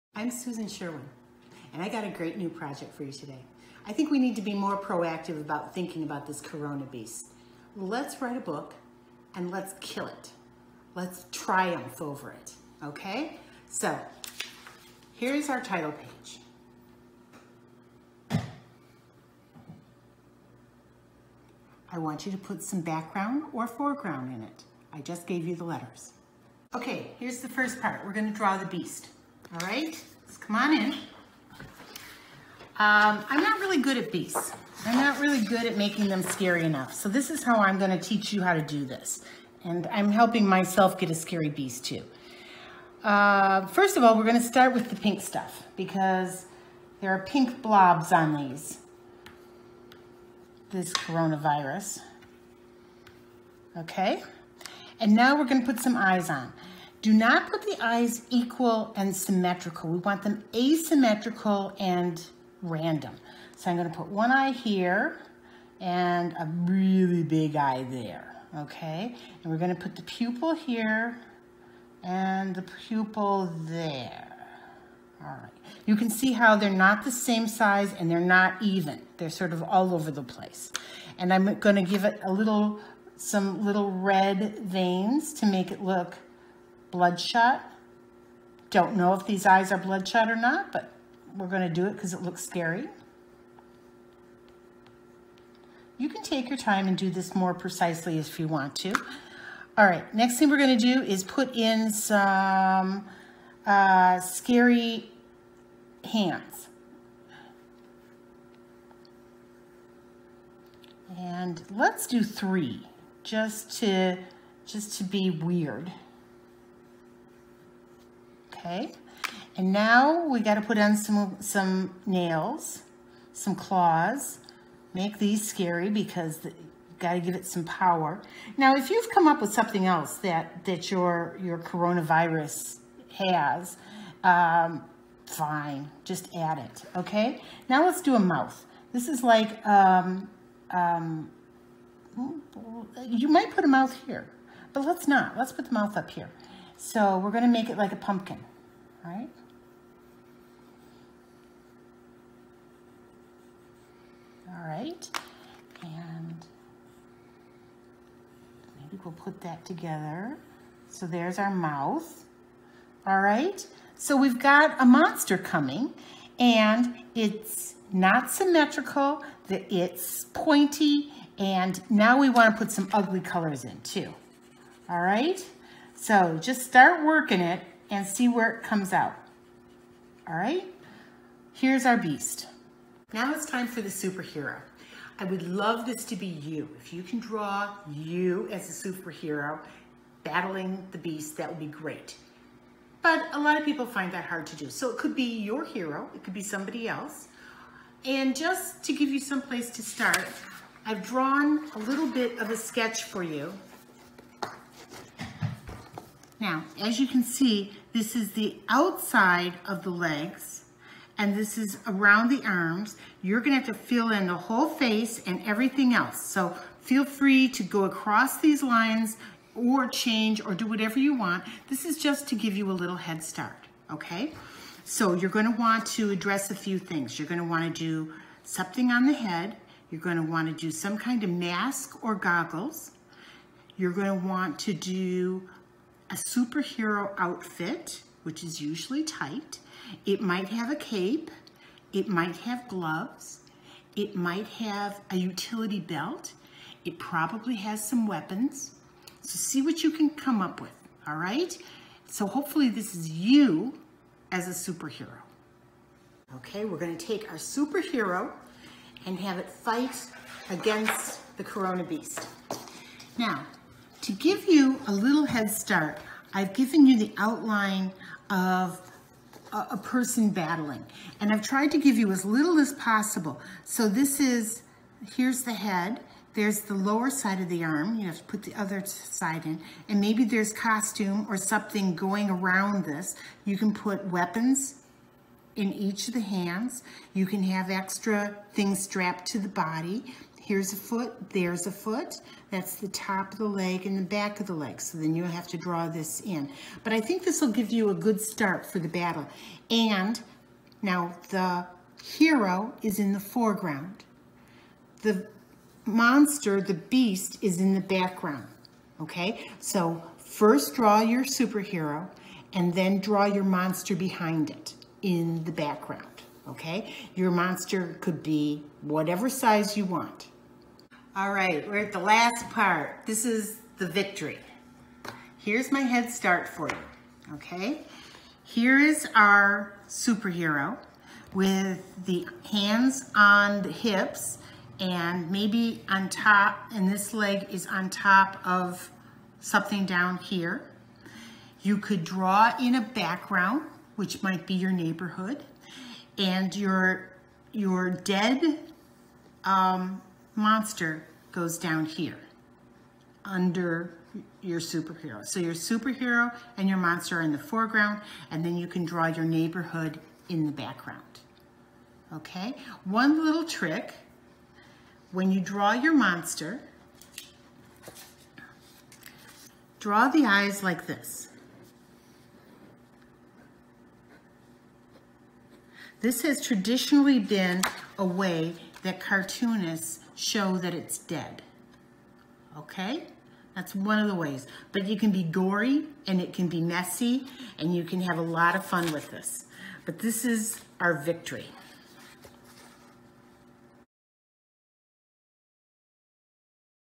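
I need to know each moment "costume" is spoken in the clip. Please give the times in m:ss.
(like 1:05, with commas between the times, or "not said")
4:40.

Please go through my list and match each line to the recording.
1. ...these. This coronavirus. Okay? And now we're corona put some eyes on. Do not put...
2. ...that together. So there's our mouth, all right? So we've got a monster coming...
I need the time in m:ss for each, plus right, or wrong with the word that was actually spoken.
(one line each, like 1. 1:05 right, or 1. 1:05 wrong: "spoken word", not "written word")
1. 0:48 wrong: "gonna", not "corona"
2. 2:39 right.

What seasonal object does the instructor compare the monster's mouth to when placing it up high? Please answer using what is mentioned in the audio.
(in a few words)
a pumpkin.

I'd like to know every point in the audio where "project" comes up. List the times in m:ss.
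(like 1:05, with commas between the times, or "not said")
0:02.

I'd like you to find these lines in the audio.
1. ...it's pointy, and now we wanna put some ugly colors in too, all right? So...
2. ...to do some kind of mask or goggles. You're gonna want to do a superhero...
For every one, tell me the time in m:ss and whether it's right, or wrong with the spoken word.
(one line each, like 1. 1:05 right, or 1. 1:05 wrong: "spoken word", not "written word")
1. 2:49 right
2. 3:50 right.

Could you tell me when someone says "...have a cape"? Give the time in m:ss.
4:00.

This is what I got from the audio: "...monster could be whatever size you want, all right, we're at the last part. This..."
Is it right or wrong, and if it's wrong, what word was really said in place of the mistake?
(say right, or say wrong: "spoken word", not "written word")
right.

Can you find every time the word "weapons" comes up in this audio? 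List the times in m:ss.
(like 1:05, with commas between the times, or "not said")
4:08, 4:44.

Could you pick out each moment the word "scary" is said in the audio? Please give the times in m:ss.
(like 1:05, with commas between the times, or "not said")
0:36, 0:41, 1:32, 1:44, 2:05.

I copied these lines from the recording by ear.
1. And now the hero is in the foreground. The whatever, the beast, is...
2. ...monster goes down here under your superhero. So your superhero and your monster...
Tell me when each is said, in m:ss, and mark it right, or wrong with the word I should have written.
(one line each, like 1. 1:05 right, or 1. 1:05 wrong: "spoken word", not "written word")
1. 4:59 wrong: "monster", not "whatever"
2. 5:50 right.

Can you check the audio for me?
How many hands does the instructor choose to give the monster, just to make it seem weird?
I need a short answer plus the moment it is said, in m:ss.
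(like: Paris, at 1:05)
3, at 1:52.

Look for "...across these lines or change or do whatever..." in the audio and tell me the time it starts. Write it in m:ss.
3:37.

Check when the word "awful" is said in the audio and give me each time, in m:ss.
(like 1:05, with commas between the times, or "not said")
not said.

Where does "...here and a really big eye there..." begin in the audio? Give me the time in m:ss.
1:04.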